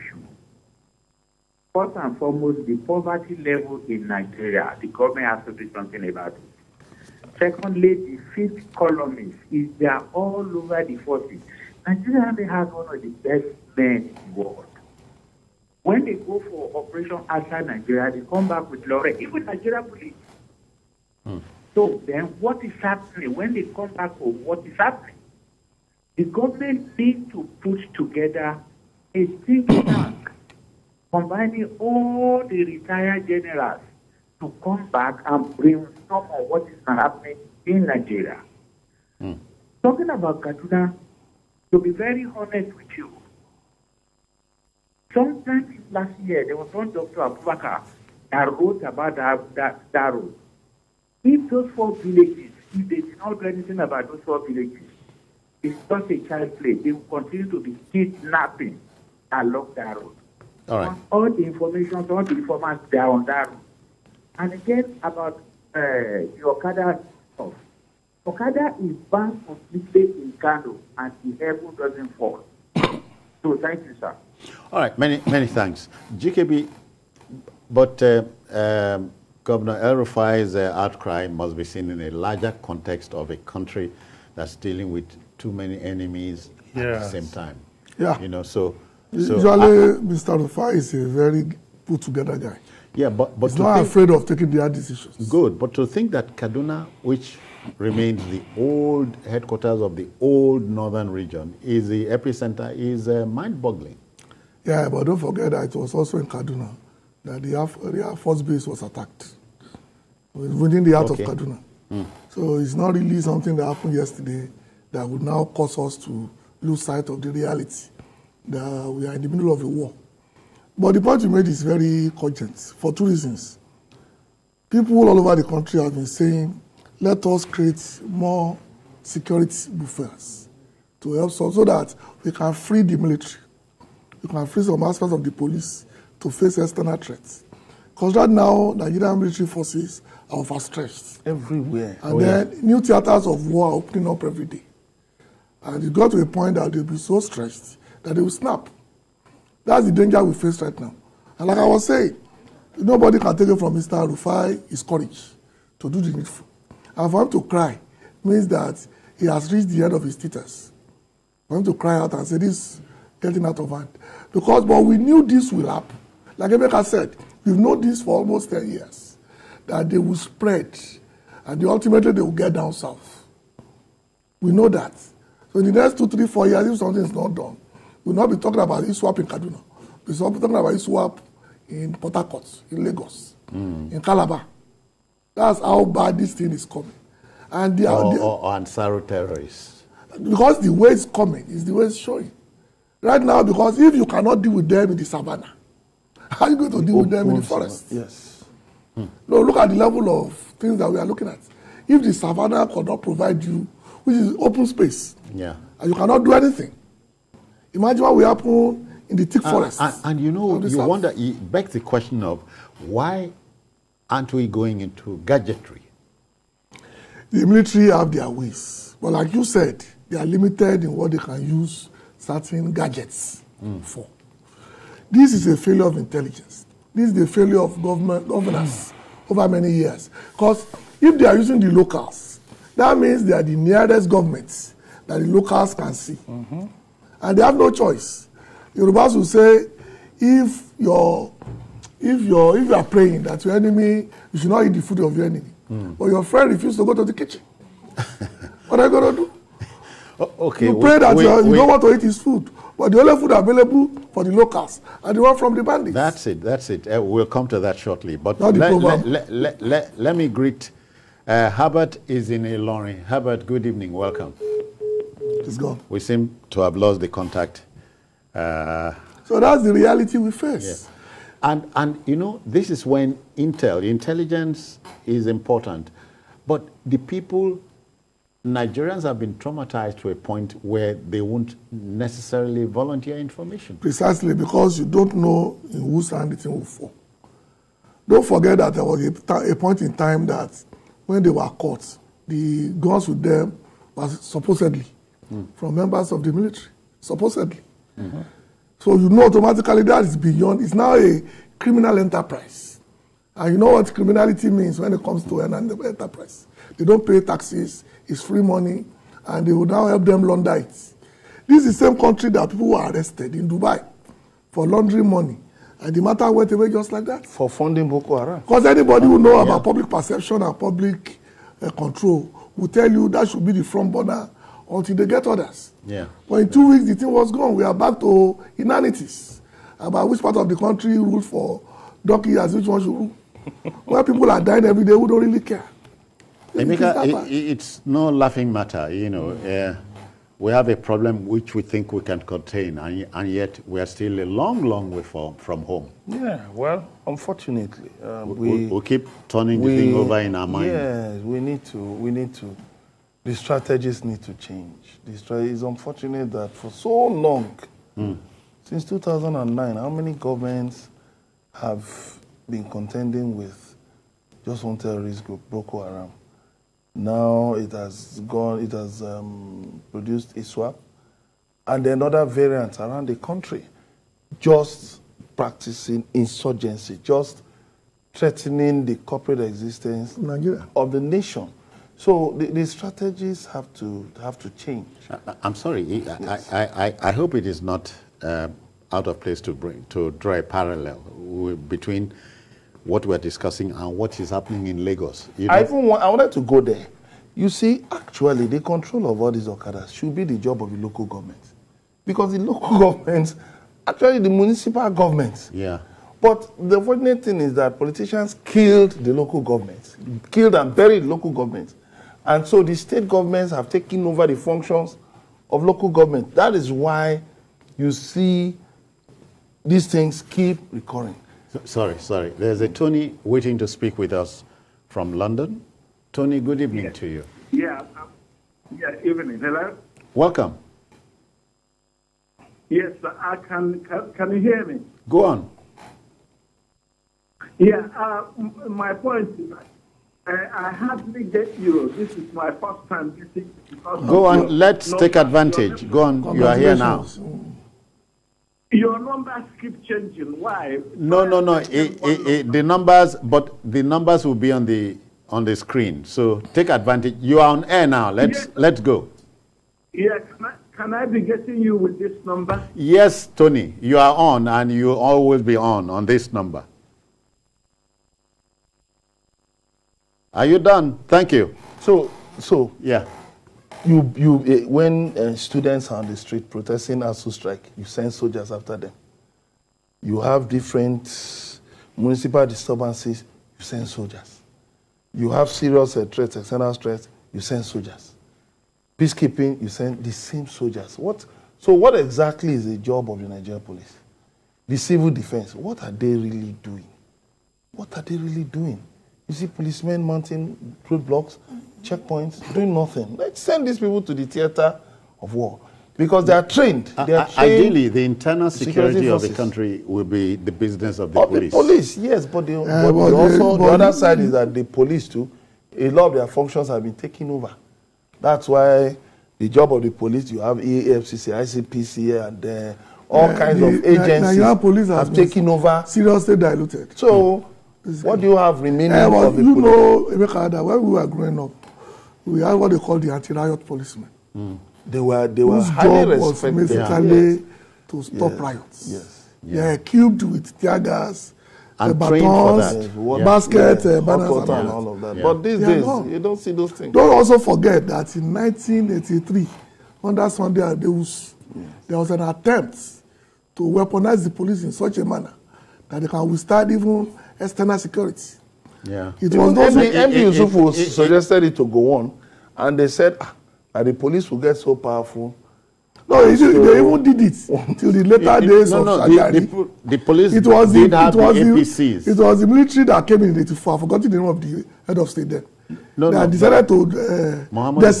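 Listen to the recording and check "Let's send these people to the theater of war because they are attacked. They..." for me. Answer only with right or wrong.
wrong.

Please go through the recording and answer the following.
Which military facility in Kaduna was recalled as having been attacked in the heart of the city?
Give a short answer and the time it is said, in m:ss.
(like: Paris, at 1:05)
Air Force Base, at 1:48.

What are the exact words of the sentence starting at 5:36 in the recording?
Emeka, it, it's no laughing matter, you know.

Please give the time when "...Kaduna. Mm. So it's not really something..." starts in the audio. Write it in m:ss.
1:51.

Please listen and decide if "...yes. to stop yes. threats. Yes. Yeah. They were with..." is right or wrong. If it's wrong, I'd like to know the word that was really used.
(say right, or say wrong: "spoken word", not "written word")
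wrong: "riots", not "threats".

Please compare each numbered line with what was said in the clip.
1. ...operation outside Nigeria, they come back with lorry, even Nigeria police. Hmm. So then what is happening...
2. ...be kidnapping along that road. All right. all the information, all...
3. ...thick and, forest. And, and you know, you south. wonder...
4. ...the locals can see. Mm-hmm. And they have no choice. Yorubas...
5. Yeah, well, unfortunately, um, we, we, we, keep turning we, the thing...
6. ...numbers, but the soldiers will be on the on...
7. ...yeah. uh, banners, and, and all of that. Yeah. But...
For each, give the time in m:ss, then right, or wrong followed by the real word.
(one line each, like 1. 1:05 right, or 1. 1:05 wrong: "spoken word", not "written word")
1. 0:16 right
2. 0:57 right
3. 3:29 right
4. 3:55 right
5. 5:46 right
6. 7:32 wrong: "numbers", not "soldiers"
7. 9:03 right.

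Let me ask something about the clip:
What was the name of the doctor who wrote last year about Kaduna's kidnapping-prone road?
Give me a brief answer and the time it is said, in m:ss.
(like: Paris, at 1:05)
Doctor Abubakar, at 0:46.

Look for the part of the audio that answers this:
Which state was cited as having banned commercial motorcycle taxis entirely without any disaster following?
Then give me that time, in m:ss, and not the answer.
1:10.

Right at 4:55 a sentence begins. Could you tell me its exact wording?
from members of the military, supposedly.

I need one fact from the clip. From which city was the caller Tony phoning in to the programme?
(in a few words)
London.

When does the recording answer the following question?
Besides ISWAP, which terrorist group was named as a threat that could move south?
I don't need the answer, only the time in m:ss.
3:08.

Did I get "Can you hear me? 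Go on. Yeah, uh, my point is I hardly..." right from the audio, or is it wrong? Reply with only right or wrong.
right.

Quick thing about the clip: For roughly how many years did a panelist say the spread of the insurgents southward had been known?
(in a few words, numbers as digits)
10.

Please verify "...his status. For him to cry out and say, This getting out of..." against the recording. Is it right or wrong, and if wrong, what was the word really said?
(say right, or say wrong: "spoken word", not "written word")
right.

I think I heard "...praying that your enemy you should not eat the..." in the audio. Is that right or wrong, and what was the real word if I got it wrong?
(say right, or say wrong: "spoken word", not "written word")
right.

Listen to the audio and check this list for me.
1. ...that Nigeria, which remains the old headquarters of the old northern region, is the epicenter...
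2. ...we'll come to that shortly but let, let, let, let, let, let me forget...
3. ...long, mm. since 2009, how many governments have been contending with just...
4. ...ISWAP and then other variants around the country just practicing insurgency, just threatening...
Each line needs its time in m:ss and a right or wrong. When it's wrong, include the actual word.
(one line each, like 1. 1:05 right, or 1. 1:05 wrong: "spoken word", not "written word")
1. 1:36 wrong: "Kaduna", not "Nigeria"
2. 4:17 wrong: "greet", not "forget"
3. 5:57 right
4. 6:10 right.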